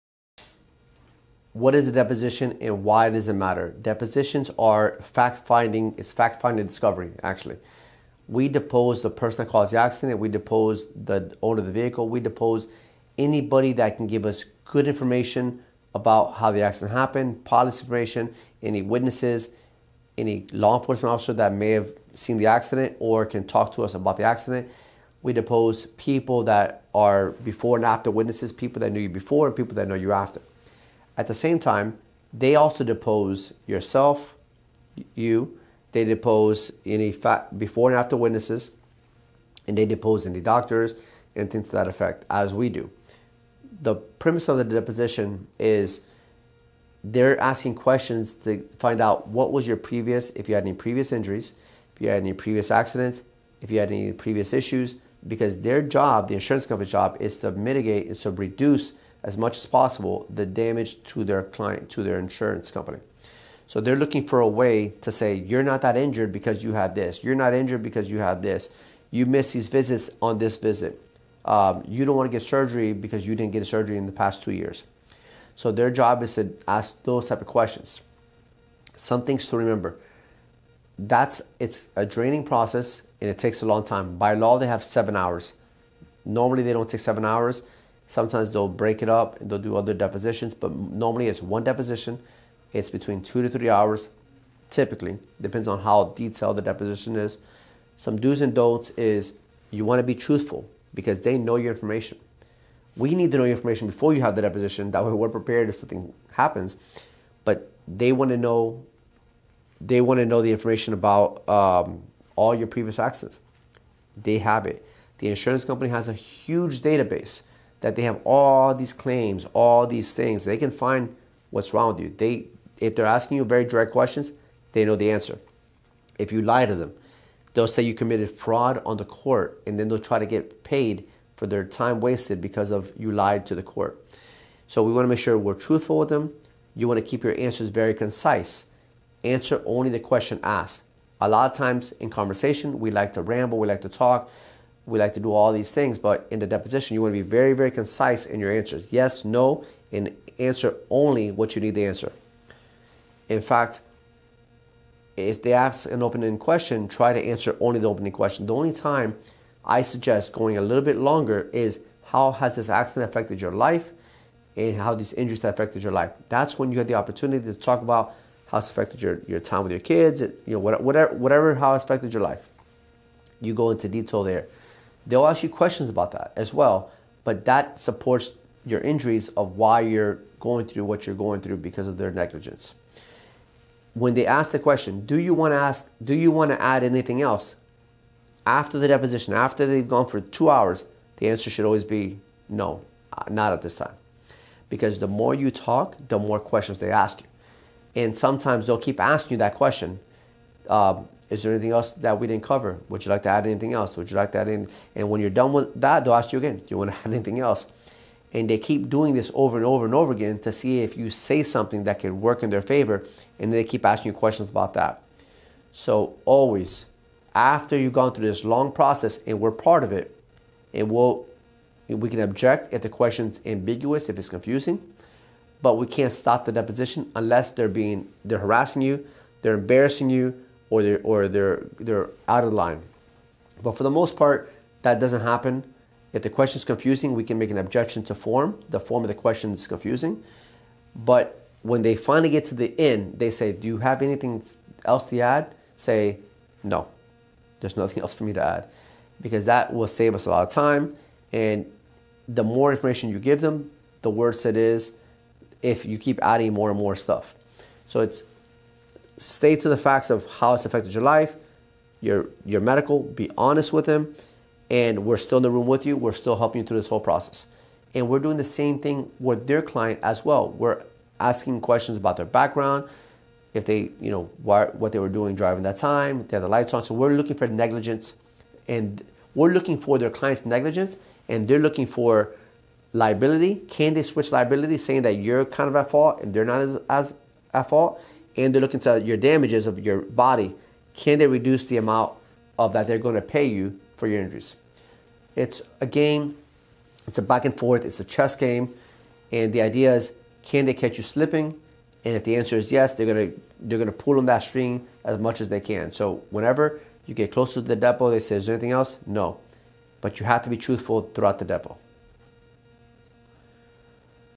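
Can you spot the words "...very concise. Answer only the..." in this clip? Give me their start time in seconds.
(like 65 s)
137 s.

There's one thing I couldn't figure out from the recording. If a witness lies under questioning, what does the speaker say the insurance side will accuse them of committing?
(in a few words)
Fraud on the court.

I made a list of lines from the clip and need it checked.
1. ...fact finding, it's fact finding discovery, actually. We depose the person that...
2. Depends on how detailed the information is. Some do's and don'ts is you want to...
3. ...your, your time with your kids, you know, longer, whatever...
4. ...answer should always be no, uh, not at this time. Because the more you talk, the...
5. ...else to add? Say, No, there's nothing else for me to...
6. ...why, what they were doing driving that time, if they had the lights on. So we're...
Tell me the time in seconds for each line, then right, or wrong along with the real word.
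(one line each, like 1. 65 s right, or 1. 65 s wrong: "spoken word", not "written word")
1. 5 s right
2. 95 s wrong: "deposition", not "information"
3. 169 s wrong: "whatever", not "longer"
4. 191 s right
5. 244 s right
6. 274 s right.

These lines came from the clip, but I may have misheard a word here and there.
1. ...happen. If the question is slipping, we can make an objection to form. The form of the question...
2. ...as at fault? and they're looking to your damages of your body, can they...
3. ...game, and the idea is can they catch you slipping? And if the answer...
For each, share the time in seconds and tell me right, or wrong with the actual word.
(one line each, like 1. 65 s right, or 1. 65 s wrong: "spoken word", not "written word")
1. 235 s wrong: "confusing", not "slipping"
2. 286 s right
3. 298 s right.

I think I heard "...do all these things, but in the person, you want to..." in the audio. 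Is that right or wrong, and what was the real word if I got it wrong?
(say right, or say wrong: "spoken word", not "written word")
wrong: "deposition", not "person".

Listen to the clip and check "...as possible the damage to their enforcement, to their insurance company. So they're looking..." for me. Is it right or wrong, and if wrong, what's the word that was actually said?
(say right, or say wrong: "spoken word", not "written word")
wrong: "client", not "enforcement".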